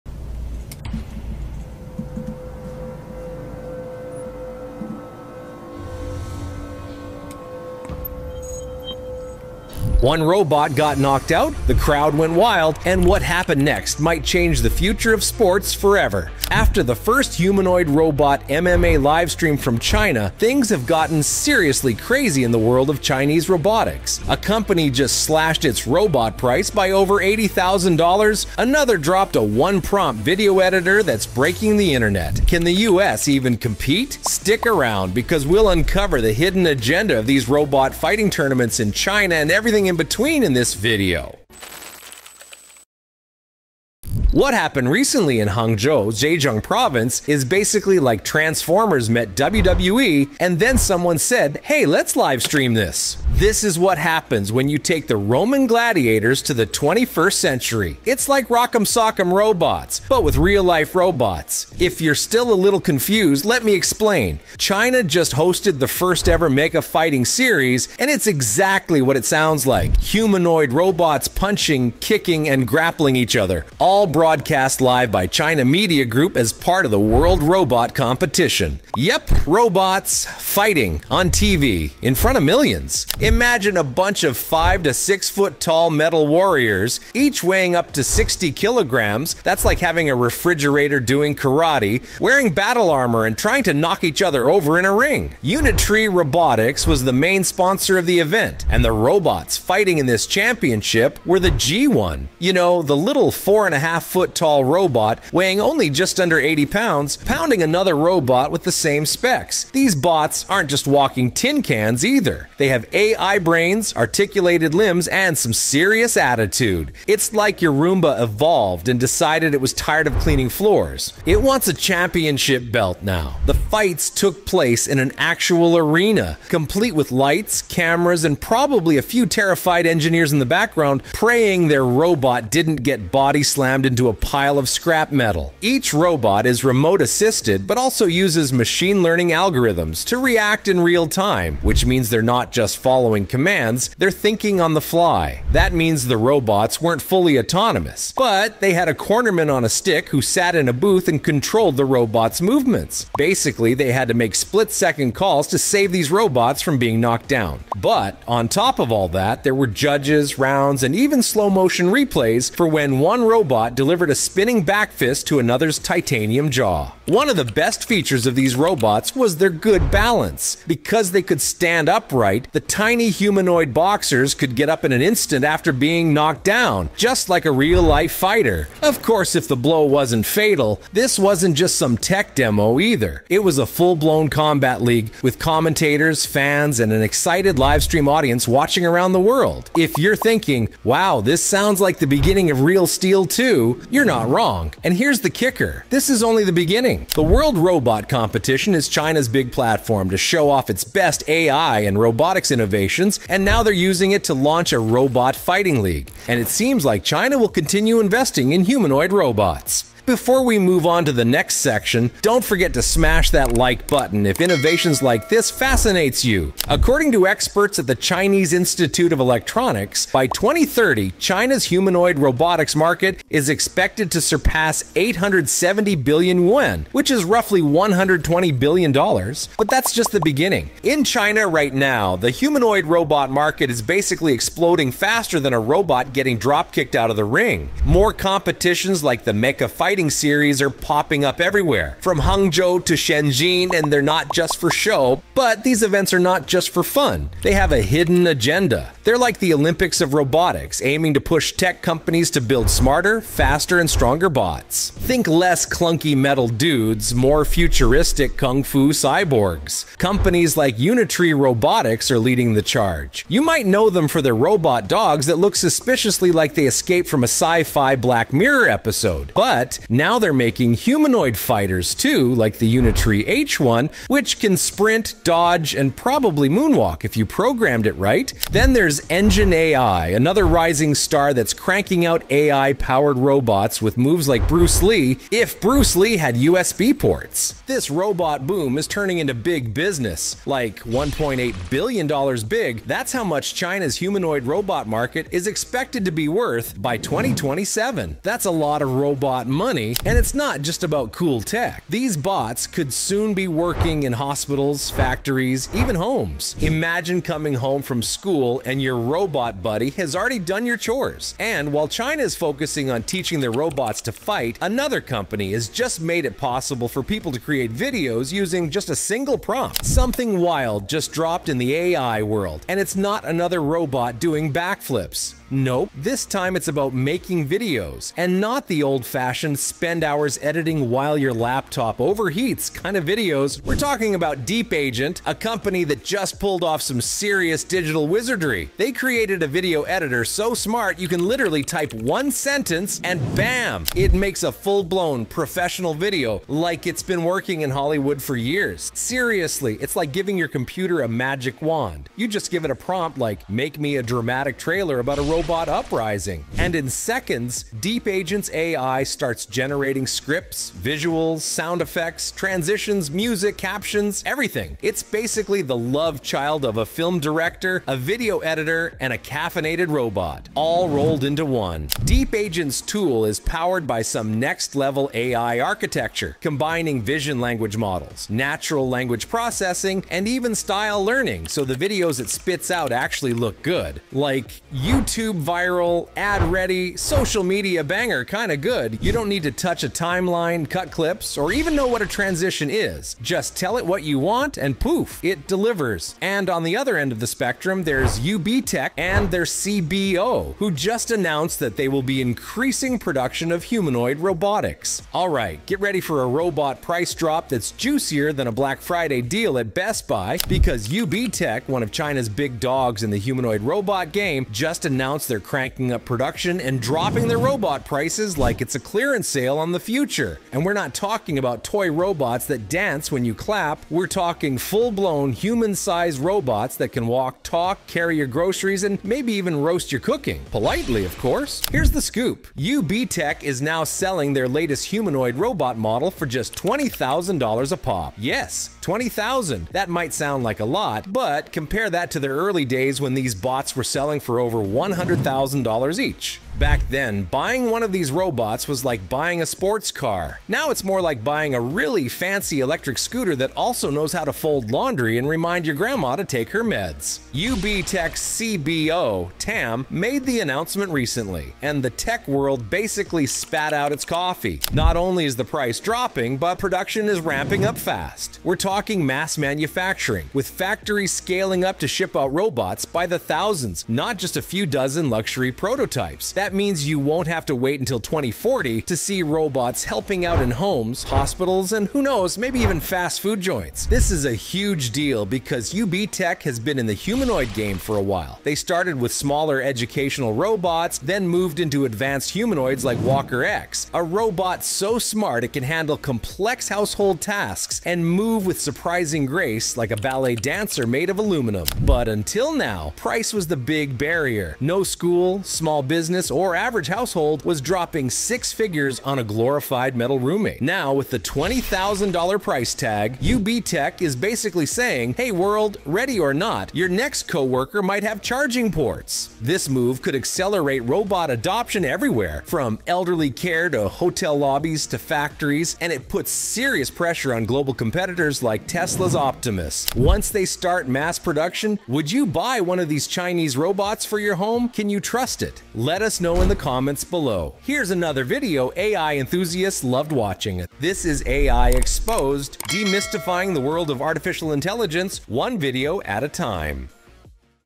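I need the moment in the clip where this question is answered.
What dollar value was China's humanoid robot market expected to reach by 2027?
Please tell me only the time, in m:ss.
4:50.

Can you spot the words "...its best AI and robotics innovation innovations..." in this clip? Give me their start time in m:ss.
3:20.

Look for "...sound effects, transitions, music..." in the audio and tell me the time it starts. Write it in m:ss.
6:01.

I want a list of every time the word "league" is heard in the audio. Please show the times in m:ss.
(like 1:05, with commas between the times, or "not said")
3:04, 3:25.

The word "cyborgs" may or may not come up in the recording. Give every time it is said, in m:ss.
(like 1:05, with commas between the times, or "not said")
4:18.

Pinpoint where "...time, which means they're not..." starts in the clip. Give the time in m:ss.
2:21.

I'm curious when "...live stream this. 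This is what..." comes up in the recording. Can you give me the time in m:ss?
0:52.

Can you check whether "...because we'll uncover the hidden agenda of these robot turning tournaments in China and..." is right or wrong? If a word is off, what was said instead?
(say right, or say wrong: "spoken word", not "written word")
wrong: "fighting", not "turning".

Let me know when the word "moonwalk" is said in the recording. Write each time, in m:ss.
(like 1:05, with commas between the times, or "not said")
4:36.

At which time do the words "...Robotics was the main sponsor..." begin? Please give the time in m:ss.
1:36.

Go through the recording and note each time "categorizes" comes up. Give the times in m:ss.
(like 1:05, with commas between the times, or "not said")
not said.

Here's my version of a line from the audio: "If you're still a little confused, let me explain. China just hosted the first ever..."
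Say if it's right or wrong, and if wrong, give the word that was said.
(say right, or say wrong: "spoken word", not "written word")
right.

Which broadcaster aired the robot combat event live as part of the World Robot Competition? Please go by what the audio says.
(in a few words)
China Media Group.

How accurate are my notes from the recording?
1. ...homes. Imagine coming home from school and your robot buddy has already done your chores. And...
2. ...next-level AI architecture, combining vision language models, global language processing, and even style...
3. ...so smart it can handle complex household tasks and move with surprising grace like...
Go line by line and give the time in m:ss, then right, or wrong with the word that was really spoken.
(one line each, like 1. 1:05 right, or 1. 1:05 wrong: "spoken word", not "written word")
1. 5:05 right
2. 6:14 wrong: "natural", not "global"
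3. 8:14 right.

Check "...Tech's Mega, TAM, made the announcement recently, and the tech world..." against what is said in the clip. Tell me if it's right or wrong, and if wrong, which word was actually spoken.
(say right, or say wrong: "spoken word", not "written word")
wrong: "CBO", not "Mega".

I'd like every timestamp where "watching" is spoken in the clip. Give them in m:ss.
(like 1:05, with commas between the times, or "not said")
3:08, 9:00.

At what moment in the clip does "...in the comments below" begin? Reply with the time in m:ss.
8:56.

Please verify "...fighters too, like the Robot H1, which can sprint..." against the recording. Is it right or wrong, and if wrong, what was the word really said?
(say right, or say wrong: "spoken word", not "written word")
wrong: "Unitree", not "Robot".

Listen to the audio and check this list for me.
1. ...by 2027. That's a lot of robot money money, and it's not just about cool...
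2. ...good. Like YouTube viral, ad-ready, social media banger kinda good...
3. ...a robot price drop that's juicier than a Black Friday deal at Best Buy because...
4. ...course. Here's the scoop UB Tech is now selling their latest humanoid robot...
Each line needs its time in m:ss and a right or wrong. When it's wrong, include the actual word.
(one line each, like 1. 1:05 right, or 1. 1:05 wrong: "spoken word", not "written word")
1. 4:56 right
2. 6:23 right
3. 6:46 right
4. 7:11 right.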